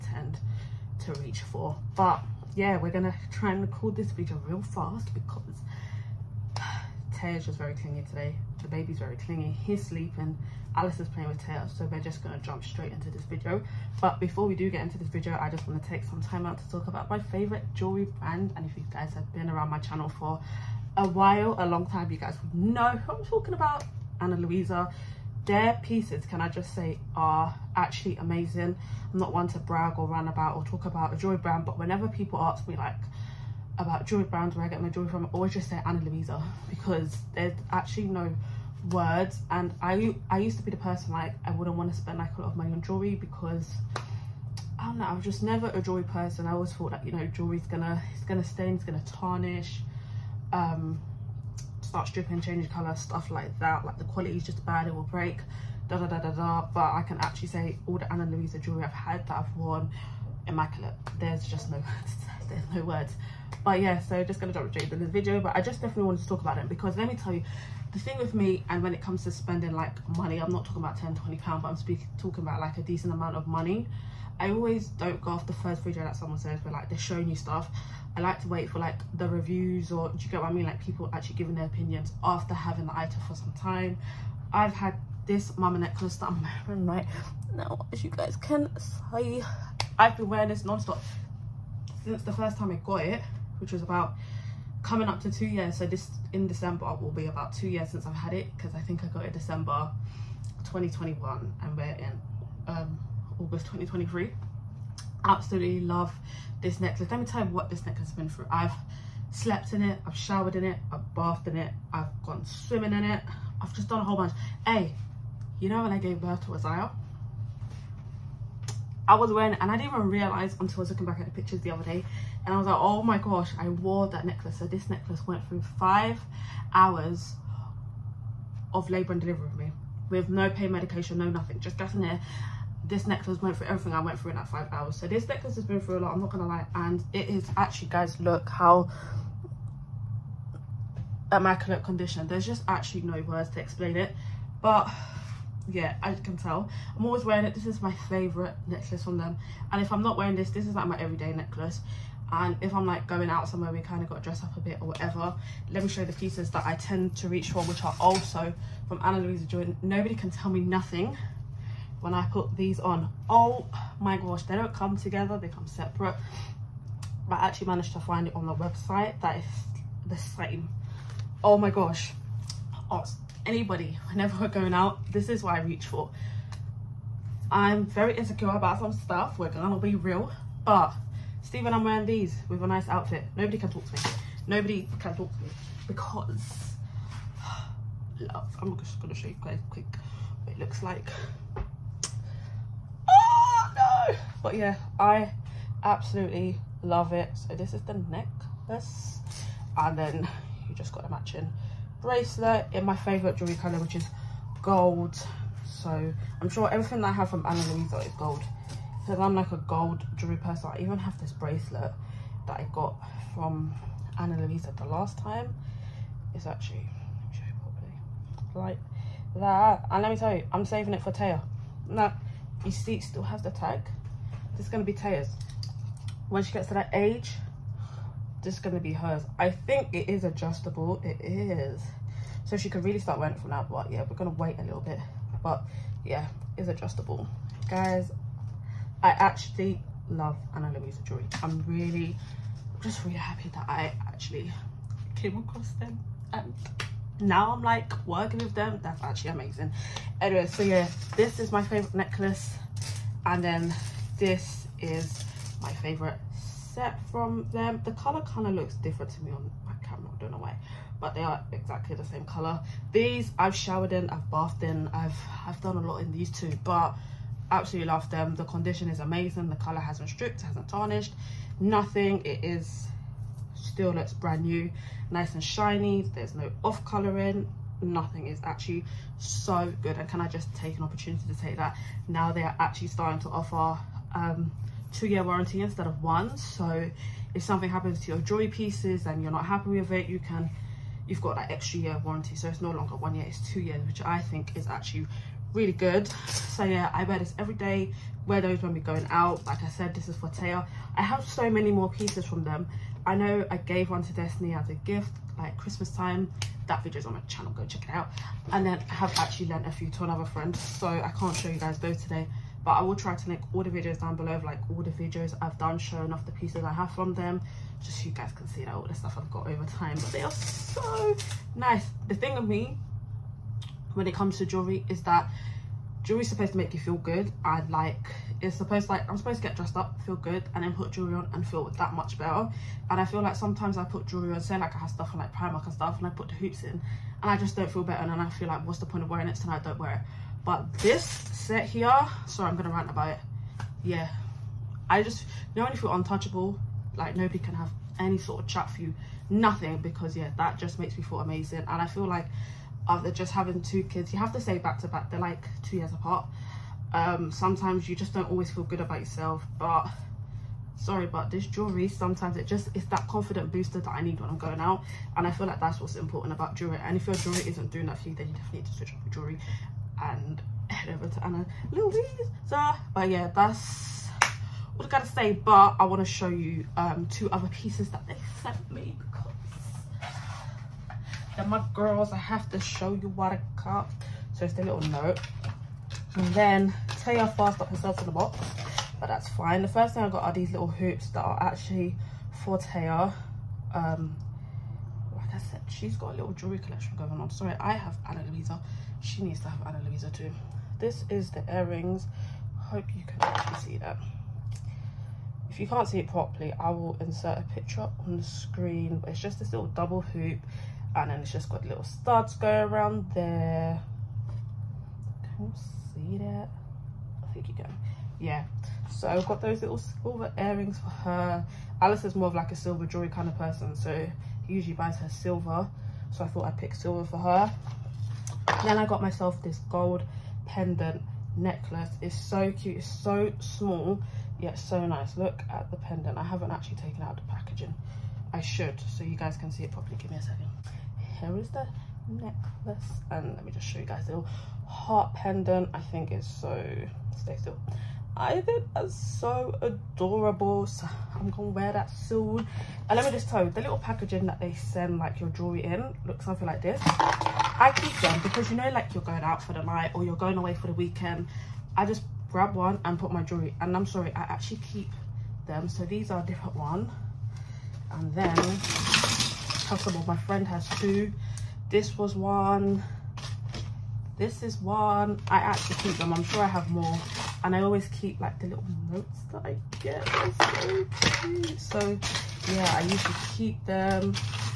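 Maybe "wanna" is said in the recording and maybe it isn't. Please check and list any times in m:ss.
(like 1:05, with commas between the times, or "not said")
0:15.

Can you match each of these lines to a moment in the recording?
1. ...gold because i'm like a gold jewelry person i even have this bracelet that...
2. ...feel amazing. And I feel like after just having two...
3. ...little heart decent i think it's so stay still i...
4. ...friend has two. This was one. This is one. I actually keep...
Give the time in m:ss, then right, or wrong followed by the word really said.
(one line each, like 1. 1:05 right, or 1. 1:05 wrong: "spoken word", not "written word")
1. 3:28 right
2. 5:51 right
3. 7:24 wrong: "pendant", not "decent"
4. 7:50 right.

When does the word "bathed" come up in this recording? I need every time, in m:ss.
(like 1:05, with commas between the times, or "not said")
1:51, 4:24.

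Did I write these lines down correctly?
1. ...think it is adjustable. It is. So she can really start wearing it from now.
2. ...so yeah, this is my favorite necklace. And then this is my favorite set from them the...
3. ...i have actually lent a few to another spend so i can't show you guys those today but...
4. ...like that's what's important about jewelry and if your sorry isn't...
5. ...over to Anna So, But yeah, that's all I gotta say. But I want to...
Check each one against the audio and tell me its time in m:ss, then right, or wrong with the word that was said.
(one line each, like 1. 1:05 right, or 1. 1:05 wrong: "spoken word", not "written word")
1. 3:49 right
2. 4:10 right
3. 5:08 wrong: "friend", not "spend"
4. 6:05 wrong: "jewelry", not "sorry"
5. 6:10 right.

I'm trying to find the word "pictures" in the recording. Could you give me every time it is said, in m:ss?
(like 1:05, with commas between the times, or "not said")
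2:01, 6:47.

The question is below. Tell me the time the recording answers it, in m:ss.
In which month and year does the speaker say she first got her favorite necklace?
1:39.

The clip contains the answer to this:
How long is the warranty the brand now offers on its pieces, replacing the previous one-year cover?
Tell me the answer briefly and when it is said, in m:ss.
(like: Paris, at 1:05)
2 years, at 4:44.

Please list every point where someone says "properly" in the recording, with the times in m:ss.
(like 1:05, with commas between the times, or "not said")
6:46, 7:19.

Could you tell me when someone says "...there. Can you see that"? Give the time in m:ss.
6:53.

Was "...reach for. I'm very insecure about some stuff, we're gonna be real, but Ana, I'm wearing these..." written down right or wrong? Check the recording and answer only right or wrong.
wrong.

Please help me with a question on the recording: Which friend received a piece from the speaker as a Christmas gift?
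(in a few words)
Destiny.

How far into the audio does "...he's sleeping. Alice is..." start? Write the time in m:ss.
0:09.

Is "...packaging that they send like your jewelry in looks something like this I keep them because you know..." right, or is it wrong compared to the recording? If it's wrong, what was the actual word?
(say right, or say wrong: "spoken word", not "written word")
right.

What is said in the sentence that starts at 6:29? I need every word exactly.
The first thing I got are these little hoops that are actually for Taya.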